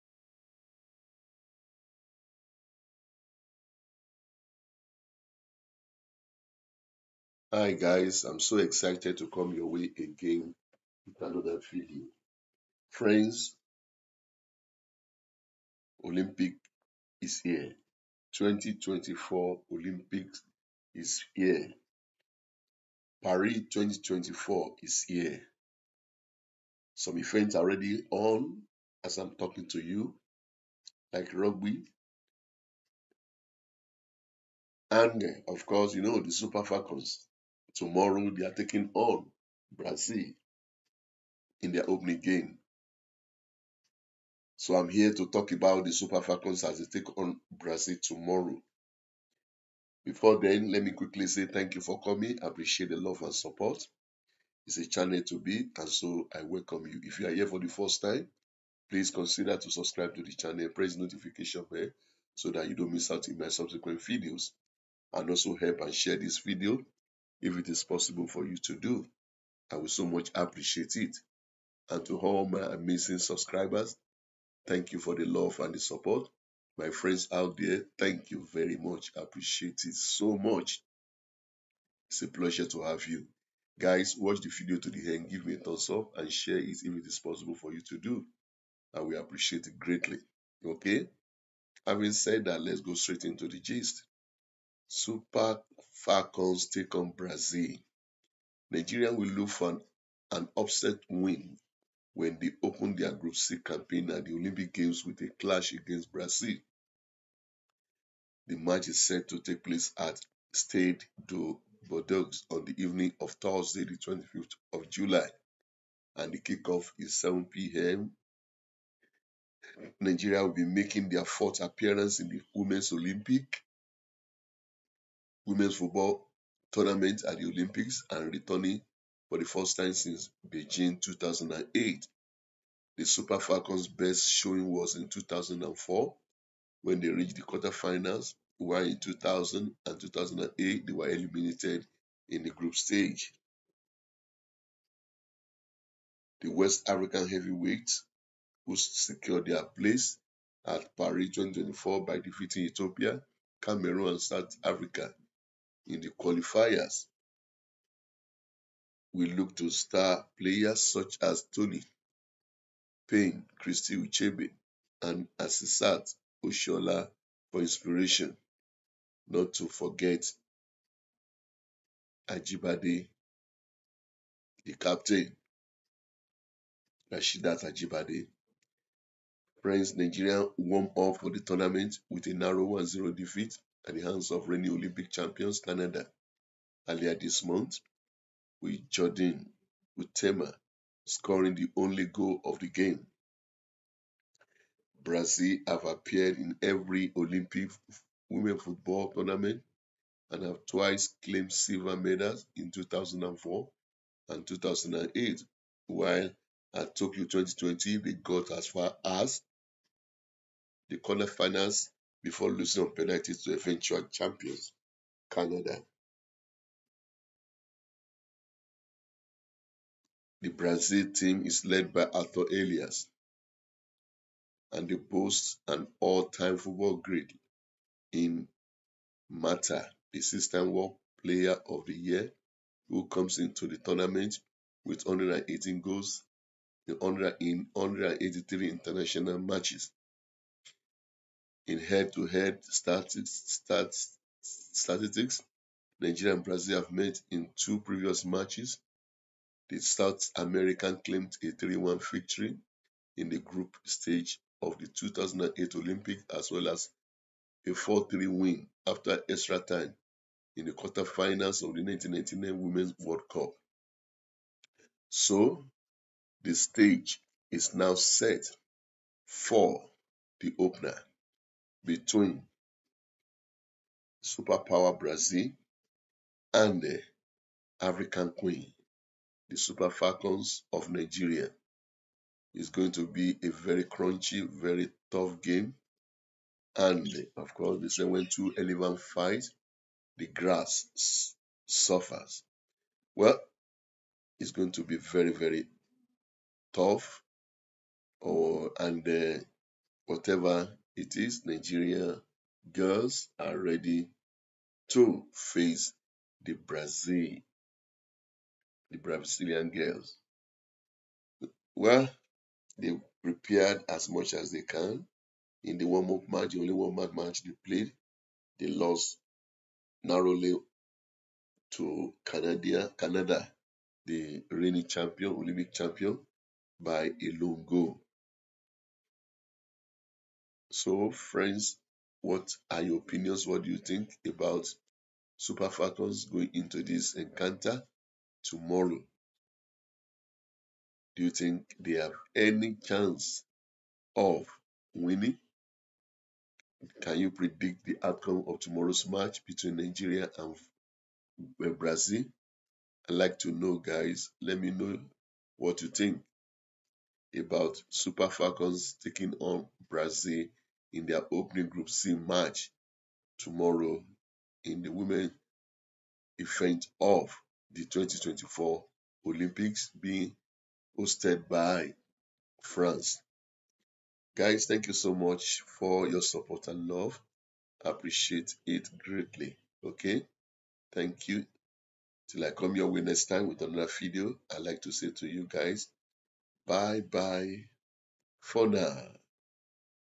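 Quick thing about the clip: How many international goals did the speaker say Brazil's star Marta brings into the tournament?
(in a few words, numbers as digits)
118.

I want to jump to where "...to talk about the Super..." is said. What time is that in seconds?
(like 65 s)
45 s.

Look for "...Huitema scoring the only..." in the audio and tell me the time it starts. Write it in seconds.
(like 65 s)
189 s.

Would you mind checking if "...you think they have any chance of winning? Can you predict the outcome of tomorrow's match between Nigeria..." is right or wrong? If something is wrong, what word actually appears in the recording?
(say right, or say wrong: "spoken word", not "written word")
right.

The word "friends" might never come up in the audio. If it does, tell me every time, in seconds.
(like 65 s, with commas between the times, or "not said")
12 s, 76 s, 331 s.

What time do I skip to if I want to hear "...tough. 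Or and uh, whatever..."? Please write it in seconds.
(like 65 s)
296 s.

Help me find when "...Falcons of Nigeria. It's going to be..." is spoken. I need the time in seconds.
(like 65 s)
279 s.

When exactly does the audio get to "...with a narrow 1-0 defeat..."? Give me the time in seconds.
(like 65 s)
182 s.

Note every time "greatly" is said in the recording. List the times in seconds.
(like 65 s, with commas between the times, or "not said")
89 s, 378 s.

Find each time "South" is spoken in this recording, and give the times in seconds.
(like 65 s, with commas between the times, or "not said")
154 s, 249 s.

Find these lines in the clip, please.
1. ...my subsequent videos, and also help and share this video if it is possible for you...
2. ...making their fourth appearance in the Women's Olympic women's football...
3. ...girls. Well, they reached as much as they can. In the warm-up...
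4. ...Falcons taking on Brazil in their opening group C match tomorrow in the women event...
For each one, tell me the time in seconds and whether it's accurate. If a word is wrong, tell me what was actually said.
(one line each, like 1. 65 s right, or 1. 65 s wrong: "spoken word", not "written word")
1. 63 s right
2. 120 s right
3. 309 s wrong: "prepared", not "reached"
4. 358 s right.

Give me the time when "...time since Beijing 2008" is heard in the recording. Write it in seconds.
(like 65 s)
129 s.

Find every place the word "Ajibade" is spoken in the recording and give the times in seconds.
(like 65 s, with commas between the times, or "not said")
172 s, 177 s.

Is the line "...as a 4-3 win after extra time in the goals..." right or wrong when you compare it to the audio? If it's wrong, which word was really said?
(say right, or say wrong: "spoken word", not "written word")
wrong: "quarterfinals", not "goals".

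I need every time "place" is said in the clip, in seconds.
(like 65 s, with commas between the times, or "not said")
109 s, 149 s.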